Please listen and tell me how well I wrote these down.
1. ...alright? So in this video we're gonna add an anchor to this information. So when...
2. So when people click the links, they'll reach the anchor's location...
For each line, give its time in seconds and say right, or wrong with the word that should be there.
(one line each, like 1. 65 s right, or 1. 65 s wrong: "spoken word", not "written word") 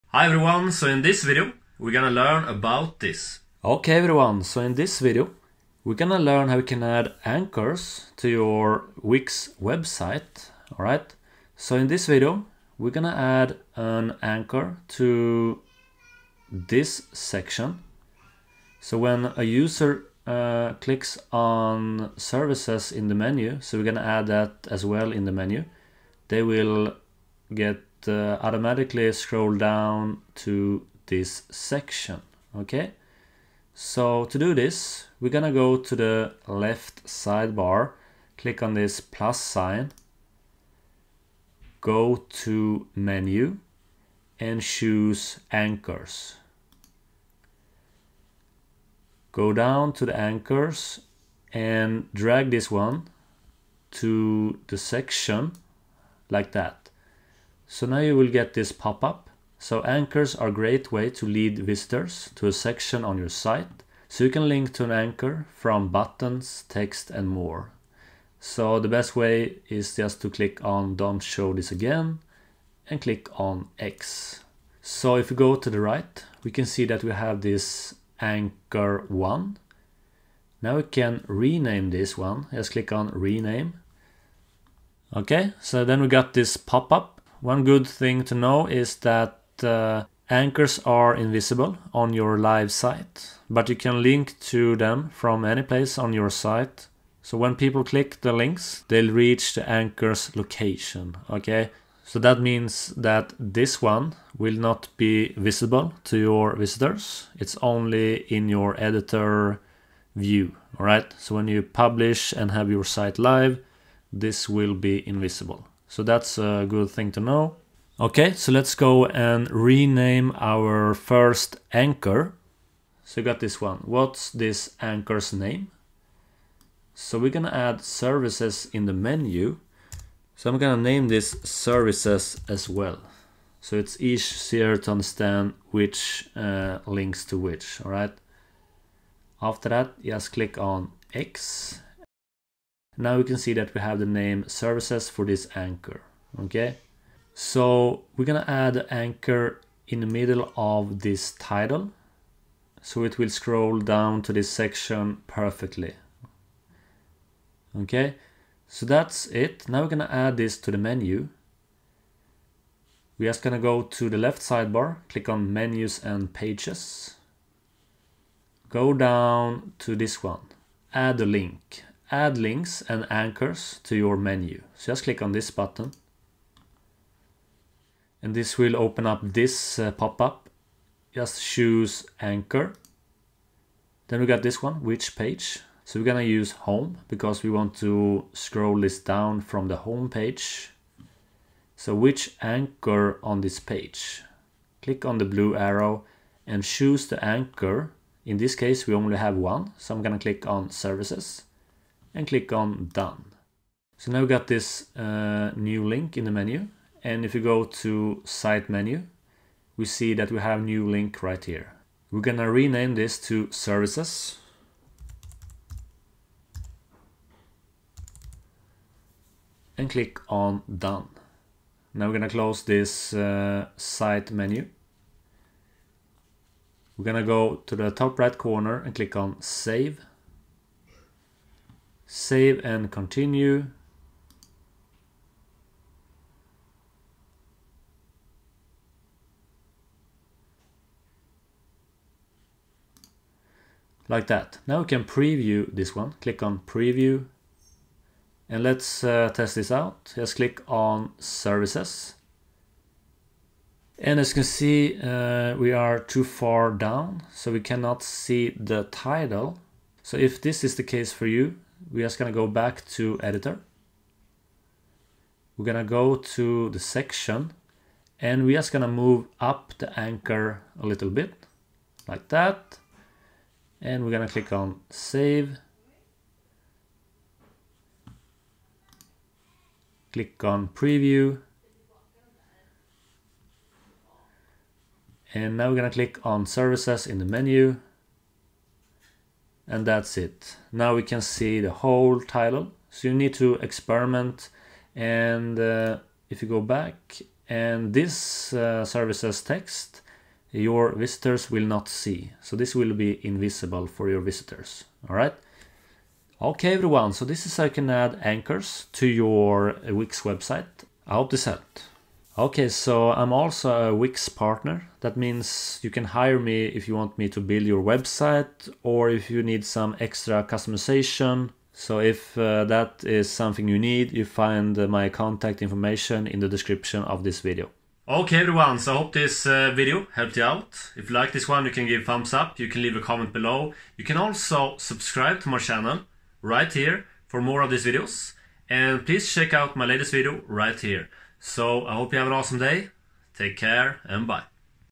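1. 10 s wrong: "section", not "information"
2. 97 s right.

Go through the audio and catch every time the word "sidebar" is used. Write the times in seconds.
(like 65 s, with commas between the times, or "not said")
37 s, 164 s.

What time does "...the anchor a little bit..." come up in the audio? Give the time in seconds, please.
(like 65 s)
269 s.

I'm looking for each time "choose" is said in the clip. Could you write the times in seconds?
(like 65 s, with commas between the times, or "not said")
44 s, 181 s, 196 s.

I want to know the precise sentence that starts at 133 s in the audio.
So it's easier to understand which uh, links to which, all right?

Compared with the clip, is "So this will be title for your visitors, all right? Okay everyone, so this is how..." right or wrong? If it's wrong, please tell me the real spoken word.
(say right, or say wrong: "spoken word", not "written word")
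wrong: "invisible", not "title".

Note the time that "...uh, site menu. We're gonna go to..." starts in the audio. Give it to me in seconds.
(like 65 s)
223 s.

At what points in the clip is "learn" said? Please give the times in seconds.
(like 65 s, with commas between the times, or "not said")
2 s, 6 s.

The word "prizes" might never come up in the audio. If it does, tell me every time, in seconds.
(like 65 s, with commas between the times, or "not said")
not said.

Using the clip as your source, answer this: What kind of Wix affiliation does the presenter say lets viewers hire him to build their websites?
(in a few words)
Wix partner.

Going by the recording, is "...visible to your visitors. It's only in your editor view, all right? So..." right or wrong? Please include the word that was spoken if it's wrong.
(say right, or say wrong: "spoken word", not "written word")
right.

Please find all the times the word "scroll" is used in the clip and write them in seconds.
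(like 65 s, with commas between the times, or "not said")
29 s, 153 s, 188 s.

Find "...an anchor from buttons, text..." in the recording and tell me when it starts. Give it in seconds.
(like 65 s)
64 s.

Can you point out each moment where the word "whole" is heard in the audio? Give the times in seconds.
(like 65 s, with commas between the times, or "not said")
291 s.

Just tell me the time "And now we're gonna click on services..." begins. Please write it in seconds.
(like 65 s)
285 s.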